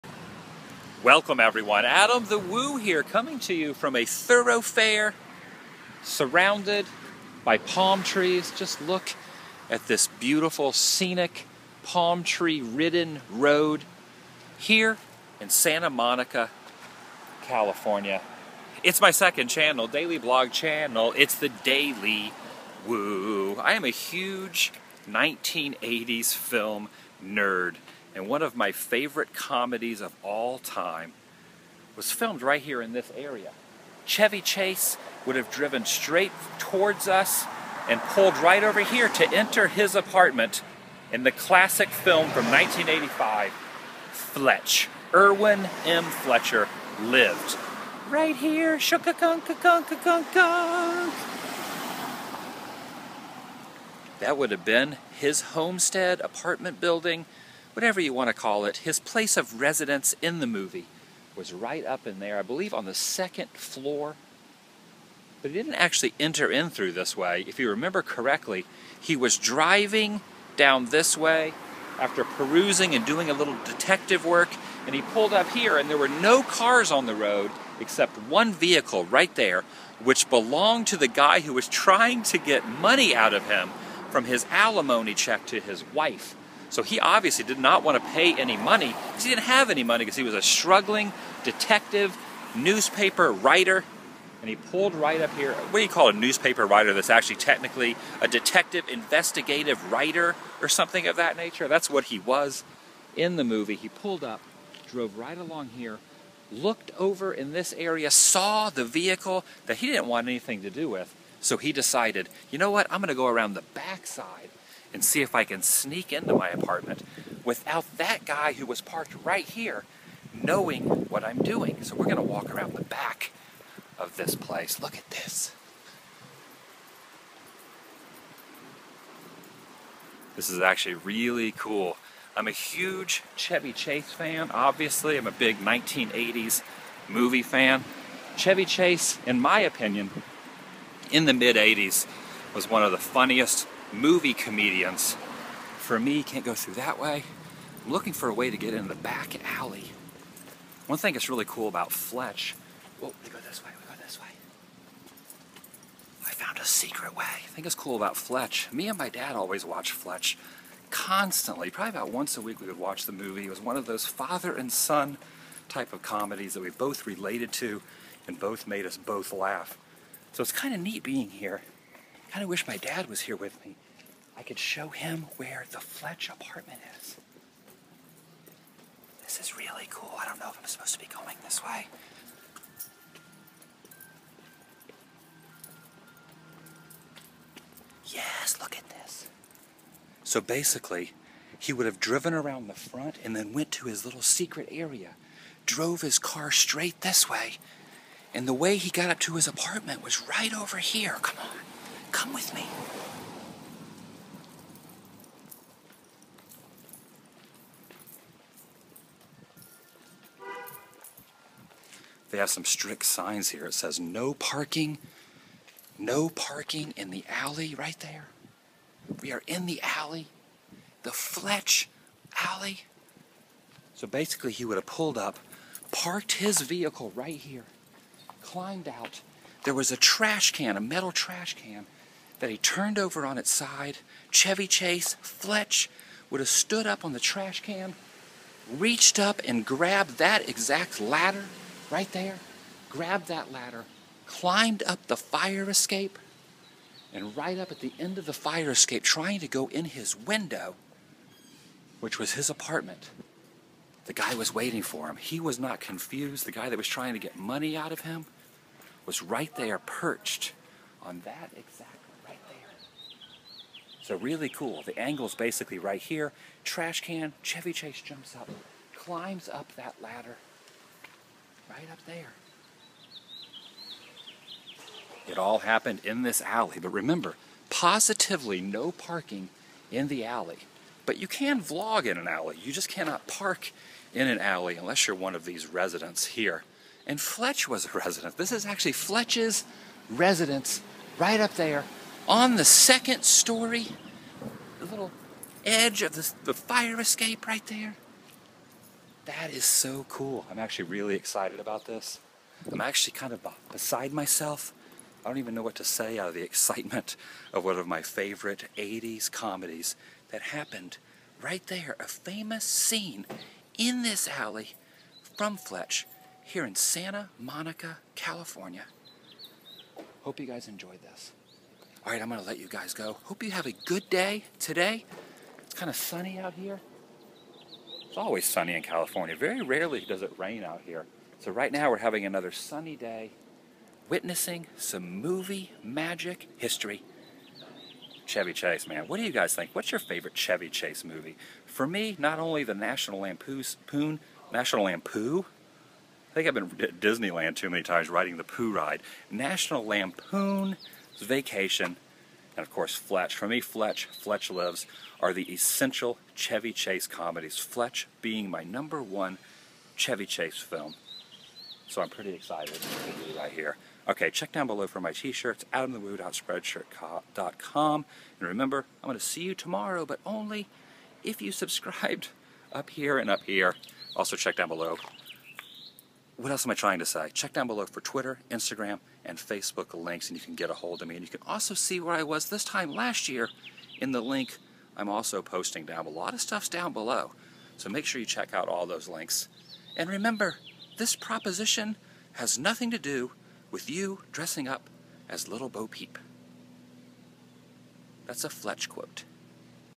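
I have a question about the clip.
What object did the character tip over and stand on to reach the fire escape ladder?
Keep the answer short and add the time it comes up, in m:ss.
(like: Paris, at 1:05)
A metal trash can, at 3:50.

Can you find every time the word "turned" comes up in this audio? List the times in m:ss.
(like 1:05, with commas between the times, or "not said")
3:52.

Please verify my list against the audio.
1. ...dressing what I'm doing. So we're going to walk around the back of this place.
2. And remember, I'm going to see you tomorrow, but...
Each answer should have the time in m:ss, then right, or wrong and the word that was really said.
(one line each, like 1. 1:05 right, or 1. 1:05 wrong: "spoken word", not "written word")
1. 2:00 wrong: "knowing", not "dressing"
2. 6:08 right.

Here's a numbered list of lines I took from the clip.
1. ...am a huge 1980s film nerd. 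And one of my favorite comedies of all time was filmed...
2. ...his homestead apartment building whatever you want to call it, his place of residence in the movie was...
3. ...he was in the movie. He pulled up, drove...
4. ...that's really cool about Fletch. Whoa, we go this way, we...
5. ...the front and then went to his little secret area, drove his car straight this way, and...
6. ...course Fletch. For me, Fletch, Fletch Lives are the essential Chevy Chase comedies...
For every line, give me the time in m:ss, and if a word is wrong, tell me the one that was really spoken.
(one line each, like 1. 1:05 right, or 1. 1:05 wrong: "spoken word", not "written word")
1. 0:23 right
2. 0:55 right
3. 1:42 right
4. 2:31 right
5. 3:12 right
6. 5:52 right.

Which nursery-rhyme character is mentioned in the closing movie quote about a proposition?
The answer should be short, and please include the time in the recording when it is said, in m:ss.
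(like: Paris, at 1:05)
Little Bo Peep, at 6:35.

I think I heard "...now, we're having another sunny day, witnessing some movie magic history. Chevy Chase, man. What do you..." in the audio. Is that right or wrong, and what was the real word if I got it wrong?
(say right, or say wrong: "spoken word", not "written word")
right.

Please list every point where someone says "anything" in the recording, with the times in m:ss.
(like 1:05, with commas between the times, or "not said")
1:50.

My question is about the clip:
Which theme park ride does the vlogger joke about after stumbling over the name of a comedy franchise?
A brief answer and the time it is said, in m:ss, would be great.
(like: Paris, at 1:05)
The Pooh ride, at 5:48.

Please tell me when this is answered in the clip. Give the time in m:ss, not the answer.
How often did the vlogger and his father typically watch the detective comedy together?
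2:41.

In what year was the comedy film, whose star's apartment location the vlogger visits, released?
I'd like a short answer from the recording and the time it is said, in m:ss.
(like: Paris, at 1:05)
1985, at 0:42.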